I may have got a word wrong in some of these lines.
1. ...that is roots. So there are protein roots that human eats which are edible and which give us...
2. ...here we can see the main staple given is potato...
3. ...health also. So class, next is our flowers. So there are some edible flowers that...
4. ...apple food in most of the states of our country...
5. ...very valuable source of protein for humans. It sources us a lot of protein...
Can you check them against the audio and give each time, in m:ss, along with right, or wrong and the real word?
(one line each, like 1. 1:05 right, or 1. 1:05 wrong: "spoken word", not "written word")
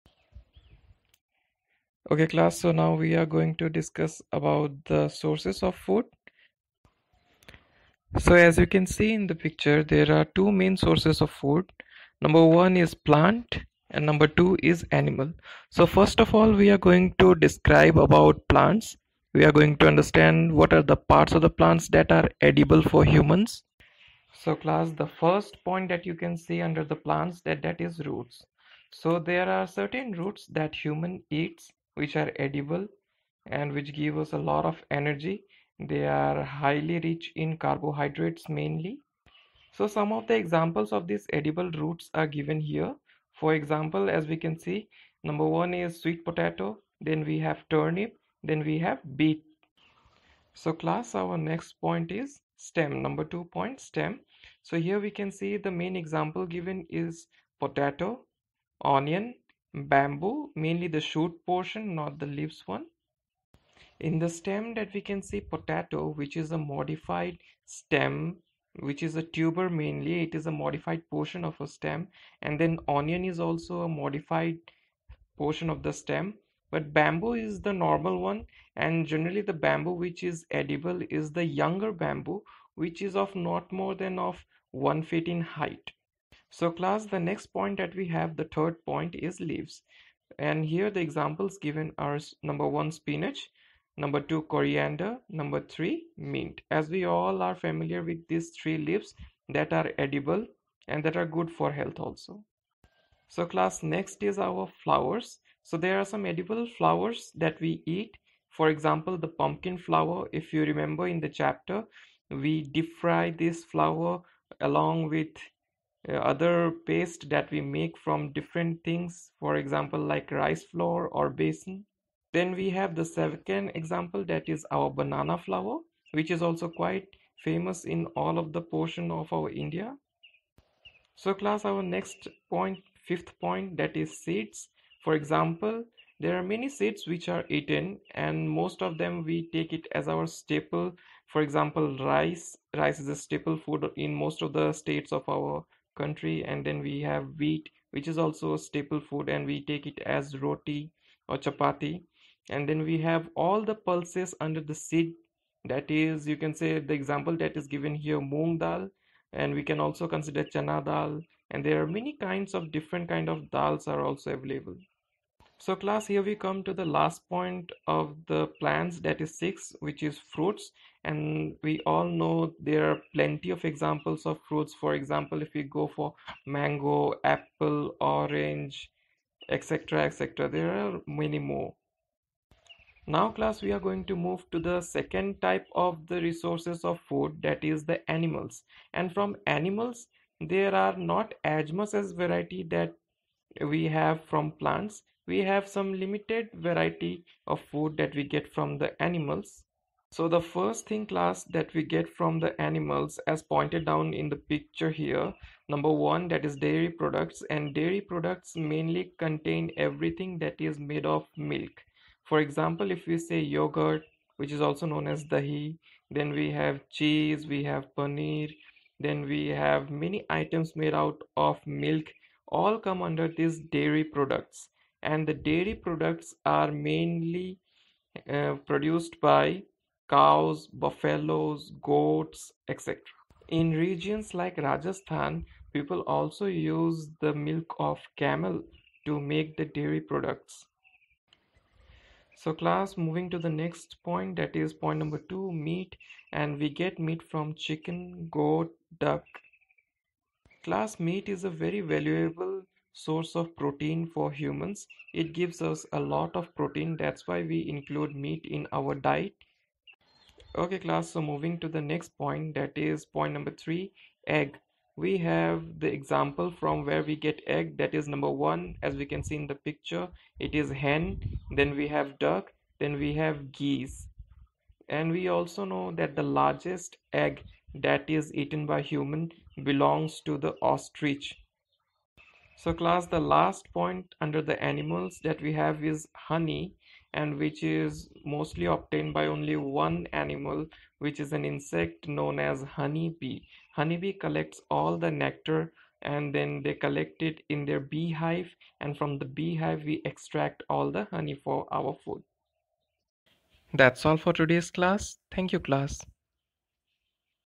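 1. 0:27 wrong: "certain", not "protein"
2. 0:54 wrong: "example", not "staple"
3. 1:41 right
4. 2:23 wrong: "staple", not "apple"
5. 4:11 wrong: "gives", not "sources".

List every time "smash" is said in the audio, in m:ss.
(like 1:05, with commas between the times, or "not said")
not said.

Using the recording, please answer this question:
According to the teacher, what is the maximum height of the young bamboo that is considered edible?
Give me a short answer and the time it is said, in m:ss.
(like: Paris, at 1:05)
1 foot, at 1:24.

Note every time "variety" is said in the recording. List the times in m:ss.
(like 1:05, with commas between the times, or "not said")
3:12, 3:16.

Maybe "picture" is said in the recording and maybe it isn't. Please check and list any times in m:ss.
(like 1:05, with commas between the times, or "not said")
0:09, 3:24, 4:29.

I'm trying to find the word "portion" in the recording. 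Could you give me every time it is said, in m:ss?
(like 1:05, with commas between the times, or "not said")
1:01, 1:11, 1:15, 2:08.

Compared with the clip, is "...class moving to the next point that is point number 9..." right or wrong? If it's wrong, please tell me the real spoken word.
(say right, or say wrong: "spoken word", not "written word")
wrong: "2", not "9".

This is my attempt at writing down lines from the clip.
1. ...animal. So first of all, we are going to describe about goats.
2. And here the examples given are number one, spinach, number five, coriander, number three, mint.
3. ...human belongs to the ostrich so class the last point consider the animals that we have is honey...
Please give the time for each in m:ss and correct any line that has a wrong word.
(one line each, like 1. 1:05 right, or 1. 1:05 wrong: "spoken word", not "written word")
1. 0:14 wrong: "plants", not "goats"
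2. 1:30 wrong: "two", not "five"
3. 4:38 wrong: "under", not "consider".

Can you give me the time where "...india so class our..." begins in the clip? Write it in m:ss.
2:09.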